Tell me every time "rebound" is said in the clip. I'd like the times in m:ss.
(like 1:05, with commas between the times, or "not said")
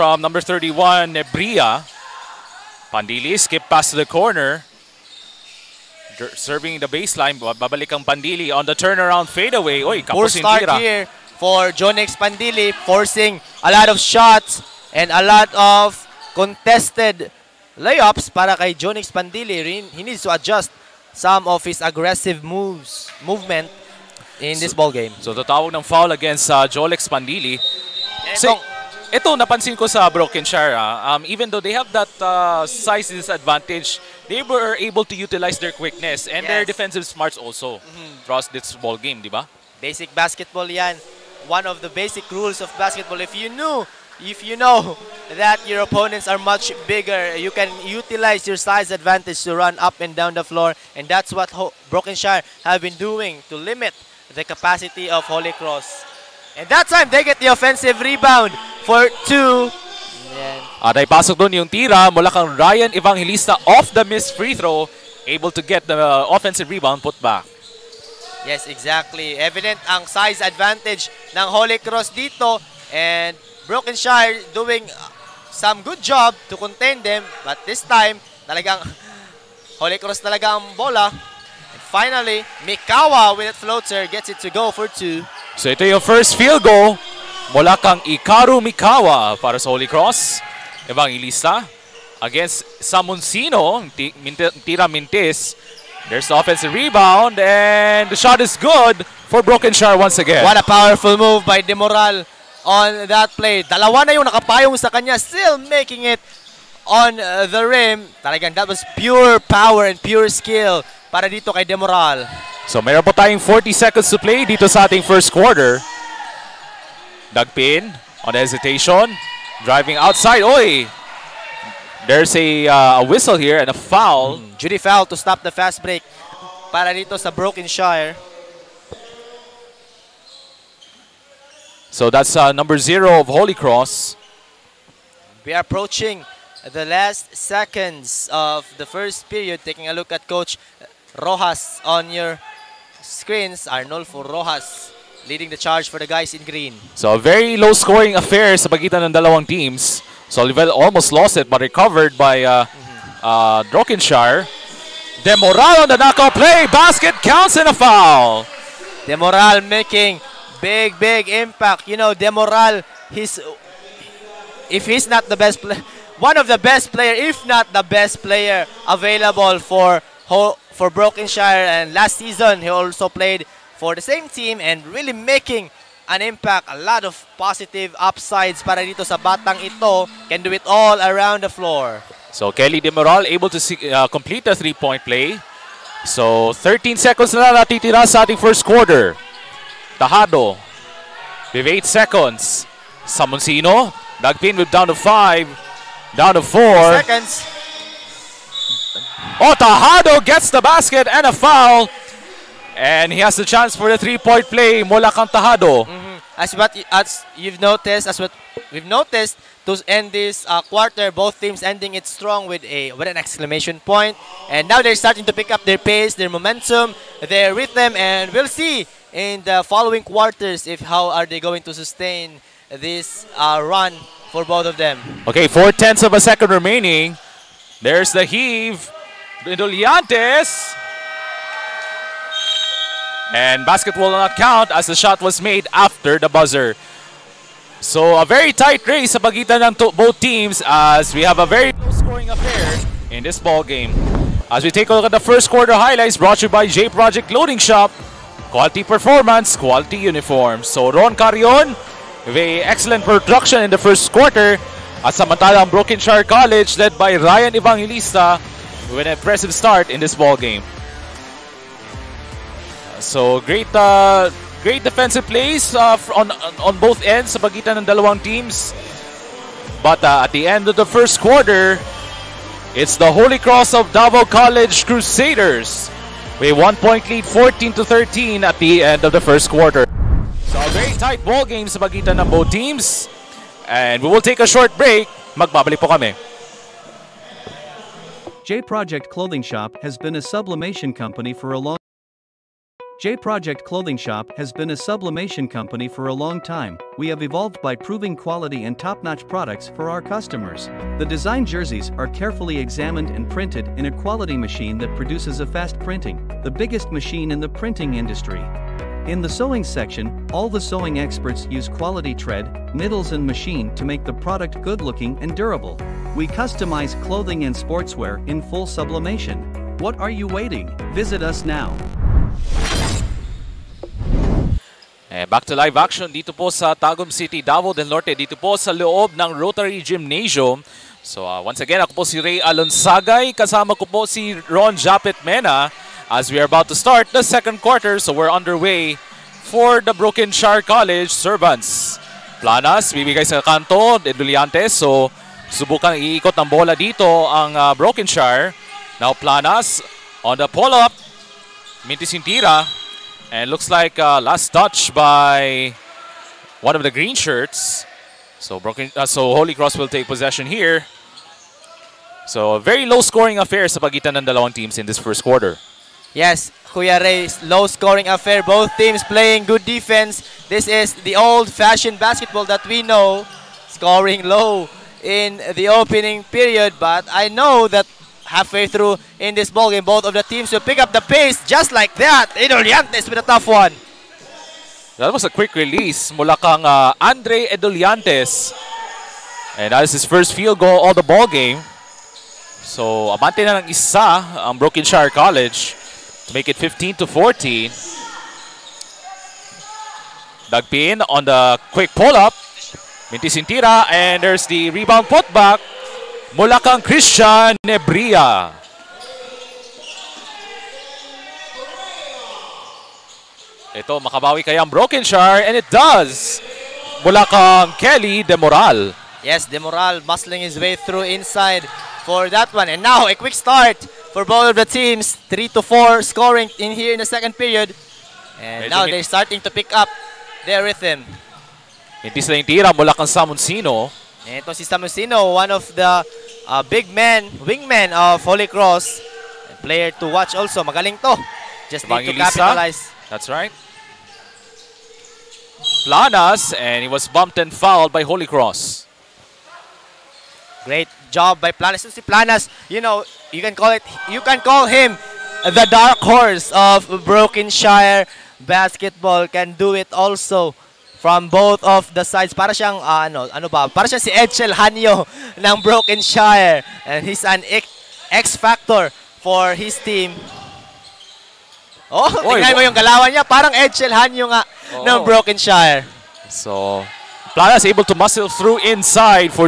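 0:58, 1:06, 1:36, 6:44.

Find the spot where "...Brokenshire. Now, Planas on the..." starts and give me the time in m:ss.
5:47.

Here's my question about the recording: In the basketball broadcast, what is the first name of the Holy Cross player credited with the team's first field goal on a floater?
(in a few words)
Ikaru.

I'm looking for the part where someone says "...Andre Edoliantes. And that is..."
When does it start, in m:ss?
6:26.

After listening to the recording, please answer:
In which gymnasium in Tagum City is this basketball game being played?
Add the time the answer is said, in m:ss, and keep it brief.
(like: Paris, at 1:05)
Rotary Gymnasium, at 5:29.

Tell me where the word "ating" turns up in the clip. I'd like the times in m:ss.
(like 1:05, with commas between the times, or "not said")
1:54, 3:08.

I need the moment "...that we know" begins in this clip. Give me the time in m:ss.
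6:12.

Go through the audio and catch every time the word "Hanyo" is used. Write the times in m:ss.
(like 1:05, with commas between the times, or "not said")
7:44, 7:53.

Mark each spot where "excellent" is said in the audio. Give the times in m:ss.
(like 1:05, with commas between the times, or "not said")
4:12.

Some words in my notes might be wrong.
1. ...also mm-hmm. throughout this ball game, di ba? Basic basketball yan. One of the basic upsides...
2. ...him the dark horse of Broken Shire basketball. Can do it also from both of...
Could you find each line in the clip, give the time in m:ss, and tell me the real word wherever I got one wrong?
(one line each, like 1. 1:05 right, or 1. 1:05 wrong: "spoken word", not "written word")
1. 0:37 wrong: "rules", not "upsides"
2. 7:34 right.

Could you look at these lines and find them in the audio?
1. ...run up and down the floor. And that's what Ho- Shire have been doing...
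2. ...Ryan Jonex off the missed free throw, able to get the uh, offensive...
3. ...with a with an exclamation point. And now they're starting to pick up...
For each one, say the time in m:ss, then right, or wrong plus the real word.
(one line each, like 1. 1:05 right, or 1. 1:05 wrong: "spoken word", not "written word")
1. 0:49 wrong: "Brokenshire", not "Shire"
2. 1:02 wrong: "Evangelista", not "Jonex"
3. 3:32 right.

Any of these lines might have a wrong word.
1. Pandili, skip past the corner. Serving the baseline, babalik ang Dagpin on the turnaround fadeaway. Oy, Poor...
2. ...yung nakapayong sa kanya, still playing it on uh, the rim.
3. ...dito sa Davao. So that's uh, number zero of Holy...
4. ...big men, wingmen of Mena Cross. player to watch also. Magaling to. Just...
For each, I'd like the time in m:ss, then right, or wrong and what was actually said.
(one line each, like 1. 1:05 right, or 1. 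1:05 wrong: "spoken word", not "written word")
1. 0:02 wrong: "Pandili", not "Dagpin"
2. 1:44 wrong: "making", not "playing"
3. 2:06 wrong: "Brokenshire", not "Davao"
4. 7:16 wrong: "Holy", not "Mena".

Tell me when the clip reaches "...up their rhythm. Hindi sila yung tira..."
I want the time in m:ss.
7:09.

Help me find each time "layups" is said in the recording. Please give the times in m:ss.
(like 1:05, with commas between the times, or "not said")
0:17.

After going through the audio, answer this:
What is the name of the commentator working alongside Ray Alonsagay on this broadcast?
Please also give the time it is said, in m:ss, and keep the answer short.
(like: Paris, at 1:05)
Ron Japet Mena, at 5:34.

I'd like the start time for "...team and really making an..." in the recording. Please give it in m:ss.
2:54.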